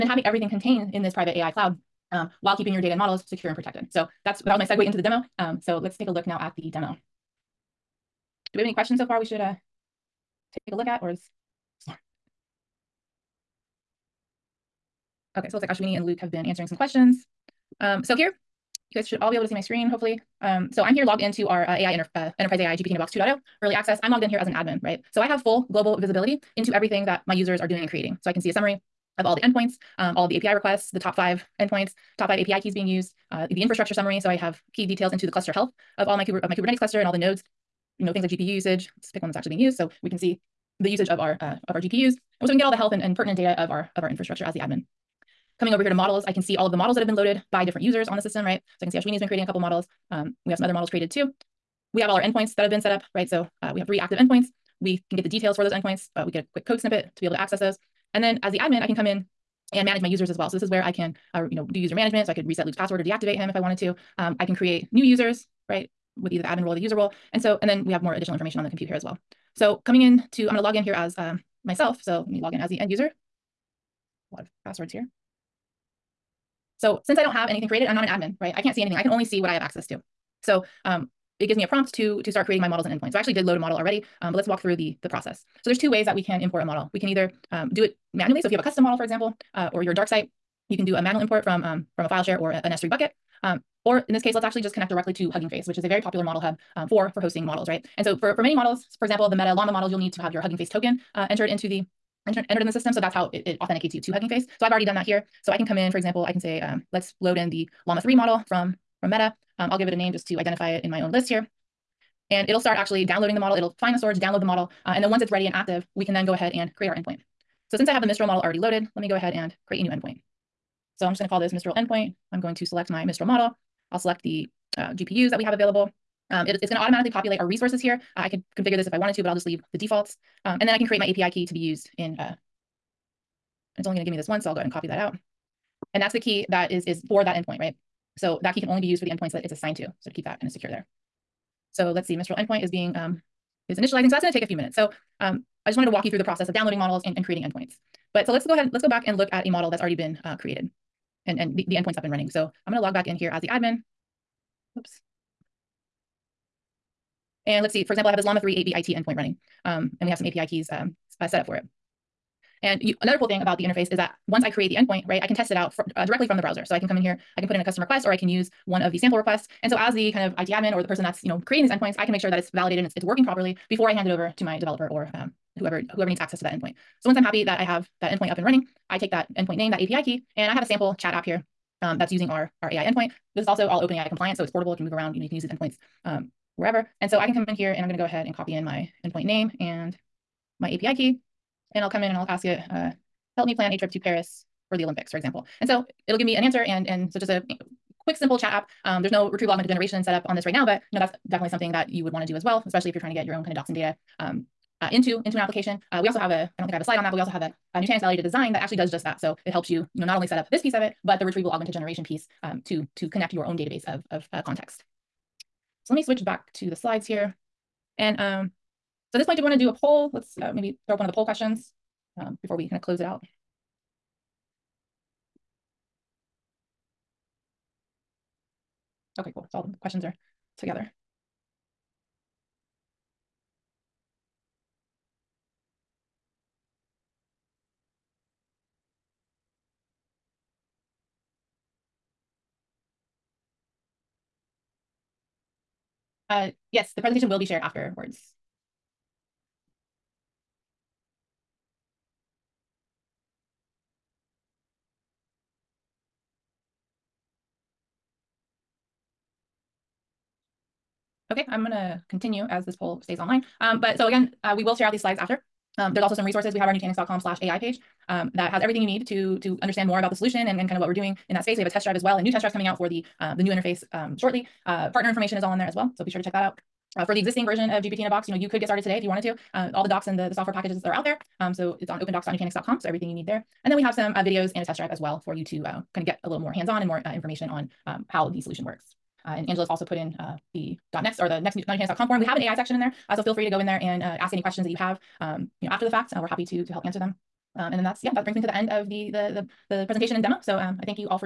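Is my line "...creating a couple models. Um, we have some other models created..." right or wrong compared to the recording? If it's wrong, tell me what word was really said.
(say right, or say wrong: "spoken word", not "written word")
right.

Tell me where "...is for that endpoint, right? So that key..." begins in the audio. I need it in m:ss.
2:16.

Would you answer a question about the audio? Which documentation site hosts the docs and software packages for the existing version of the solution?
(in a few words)
opendocs.nutanix.com.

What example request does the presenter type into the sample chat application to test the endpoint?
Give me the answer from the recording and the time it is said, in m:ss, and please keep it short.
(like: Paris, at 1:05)
Plan a trip to Paris for the Olympics, at 3:13.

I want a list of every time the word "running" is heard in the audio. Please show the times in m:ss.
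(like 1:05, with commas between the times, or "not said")
2:32, 2:39, 2:58.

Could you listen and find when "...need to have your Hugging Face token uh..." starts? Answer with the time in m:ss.
1:39.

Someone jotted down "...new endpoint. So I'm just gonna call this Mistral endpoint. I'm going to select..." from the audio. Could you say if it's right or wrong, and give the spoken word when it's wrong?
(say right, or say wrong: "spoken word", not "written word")
right.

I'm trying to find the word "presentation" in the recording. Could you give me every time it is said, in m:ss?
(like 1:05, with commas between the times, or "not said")
4:07, 4:59.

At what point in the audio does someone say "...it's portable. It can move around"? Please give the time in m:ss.
3:04.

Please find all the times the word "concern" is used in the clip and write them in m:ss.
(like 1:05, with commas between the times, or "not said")
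not said.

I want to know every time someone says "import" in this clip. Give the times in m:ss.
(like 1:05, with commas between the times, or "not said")
1:26, 1:31.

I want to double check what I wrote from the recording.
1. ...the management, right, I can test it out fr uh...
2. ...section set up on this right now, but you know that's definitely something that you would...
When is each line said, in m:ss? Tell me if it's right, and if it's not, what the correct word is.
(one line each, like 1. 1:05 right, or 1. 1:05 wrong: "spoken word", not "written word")
1. 2:44 wrong: "endpoint", not "management"
2. 3:19 wrong: "generation", not "section".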